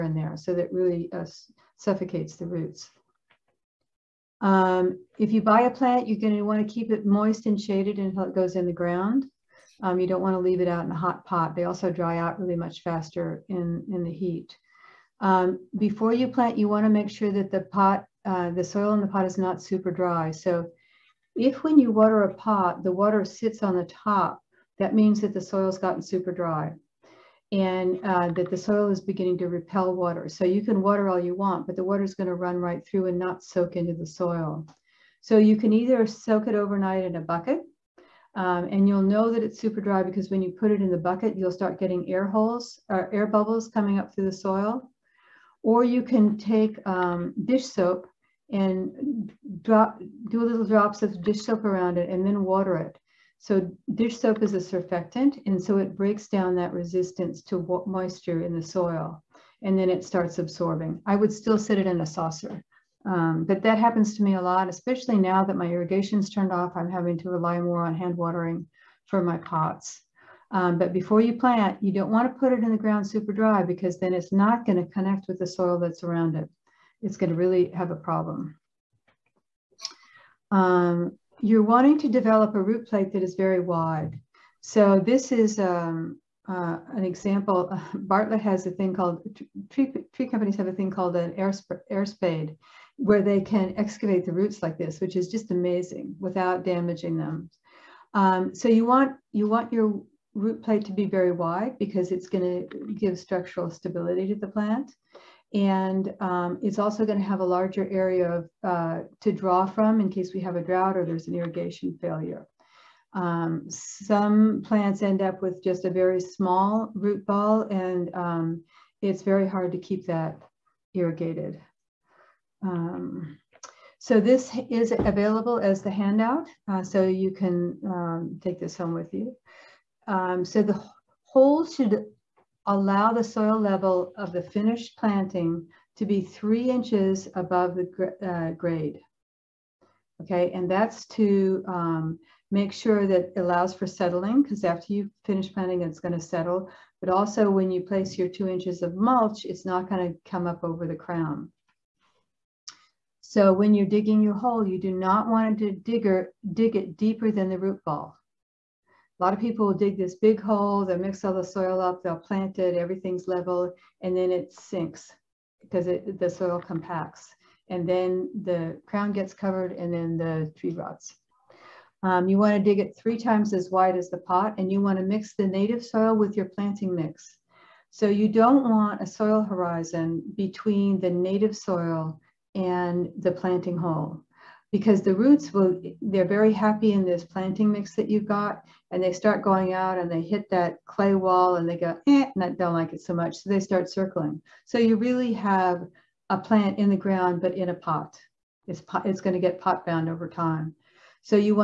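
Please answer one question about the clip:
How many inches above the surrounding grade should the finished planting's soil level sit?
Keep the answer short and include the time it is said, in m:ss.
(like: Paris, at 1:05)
3, at 2:16.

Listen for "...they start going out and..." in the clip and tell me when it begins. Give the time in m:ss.
3:09.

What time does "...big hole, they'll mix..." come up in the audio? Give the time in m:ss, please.
2:40.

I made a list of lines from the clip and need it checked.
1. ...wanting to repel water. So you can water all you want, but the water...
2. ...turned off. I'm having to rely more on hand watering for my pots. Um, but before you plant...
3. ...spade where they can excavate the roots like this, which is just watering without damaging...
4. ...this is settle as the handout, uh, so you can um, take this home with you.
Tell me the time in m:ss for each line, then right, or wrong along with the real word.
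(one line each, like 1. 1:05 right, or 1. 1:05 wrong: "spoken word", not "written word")
1. 0:29 wrong: "beginning", not "wanting"
2. 1:06 right
3. 1:32 wrong: "amazing", not "watering"
4. 2:04 wrong: "available", not "settle".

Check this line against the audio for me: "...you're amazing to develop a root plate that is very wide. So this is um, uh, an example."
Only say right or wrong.
wrong.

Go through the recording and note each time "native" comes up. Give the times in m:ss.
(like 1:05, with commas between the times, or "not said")
2:55, 3:01.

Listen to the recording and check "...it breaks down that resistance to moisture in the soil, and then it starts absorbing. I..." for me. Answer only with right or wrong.
right.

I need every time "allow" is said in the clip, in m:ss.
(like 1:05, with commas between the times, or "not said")
2:12, 2:23.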